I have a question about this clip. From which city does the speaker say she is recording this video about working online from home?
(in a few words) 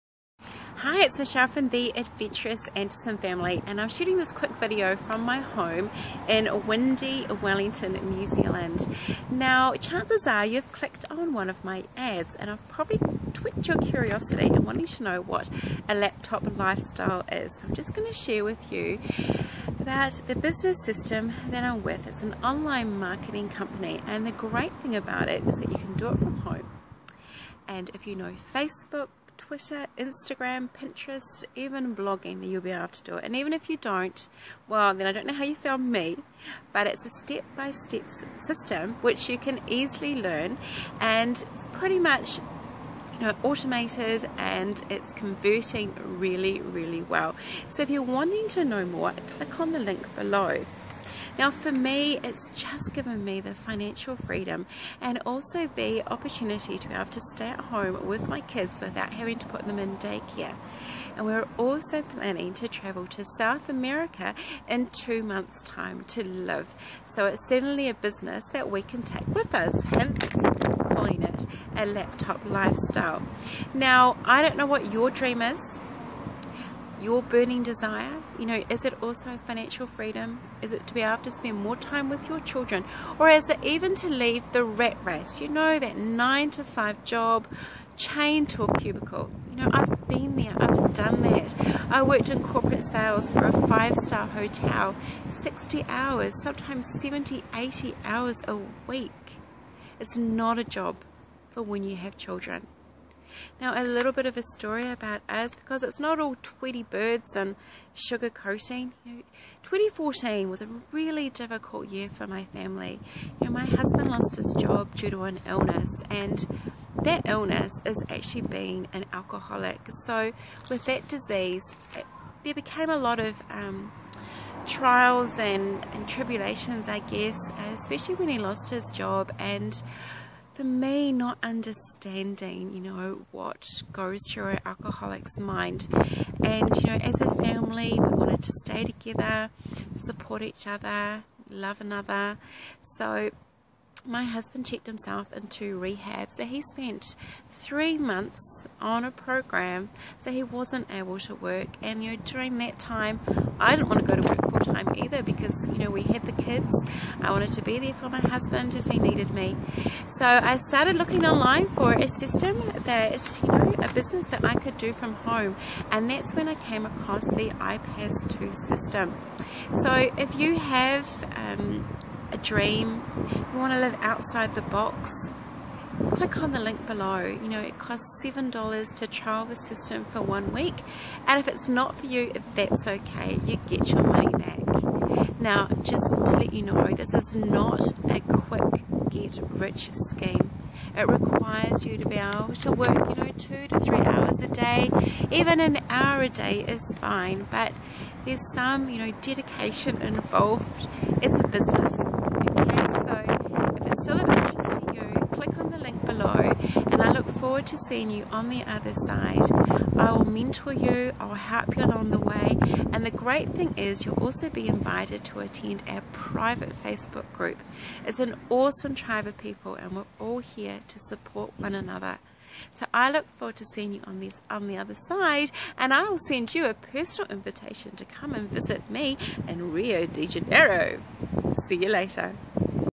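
Wellington.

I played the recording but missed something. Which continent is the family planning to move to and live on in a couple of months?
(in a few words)
South America.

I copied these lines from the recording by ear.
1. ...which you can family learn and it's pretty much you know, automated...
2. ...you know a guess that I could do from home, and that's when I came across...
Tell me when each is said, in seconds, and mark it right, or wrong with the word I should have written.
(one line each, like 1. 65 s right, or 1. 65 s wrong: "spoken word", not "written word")
1. 39 s wrong: "easily", not "family"
2. 163 s wrong: "business", not "guess".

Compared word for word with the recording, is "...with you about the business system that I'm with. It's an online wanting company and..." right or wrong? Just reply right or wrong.
wrong.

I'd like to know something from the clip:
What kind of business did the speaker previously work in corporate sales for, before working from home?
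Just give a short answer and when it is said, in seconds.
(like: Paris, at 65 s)
five star hotel, at 93 s.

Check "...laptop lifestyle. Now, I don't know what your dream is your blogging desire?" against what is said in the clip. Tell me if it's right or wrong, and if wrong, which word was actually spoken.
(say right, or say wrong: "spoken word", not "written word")
wrong: "burning", not "blogging".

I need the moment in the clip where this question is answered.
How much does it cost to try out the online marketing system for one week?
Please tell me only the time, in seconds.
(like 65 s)
178 s.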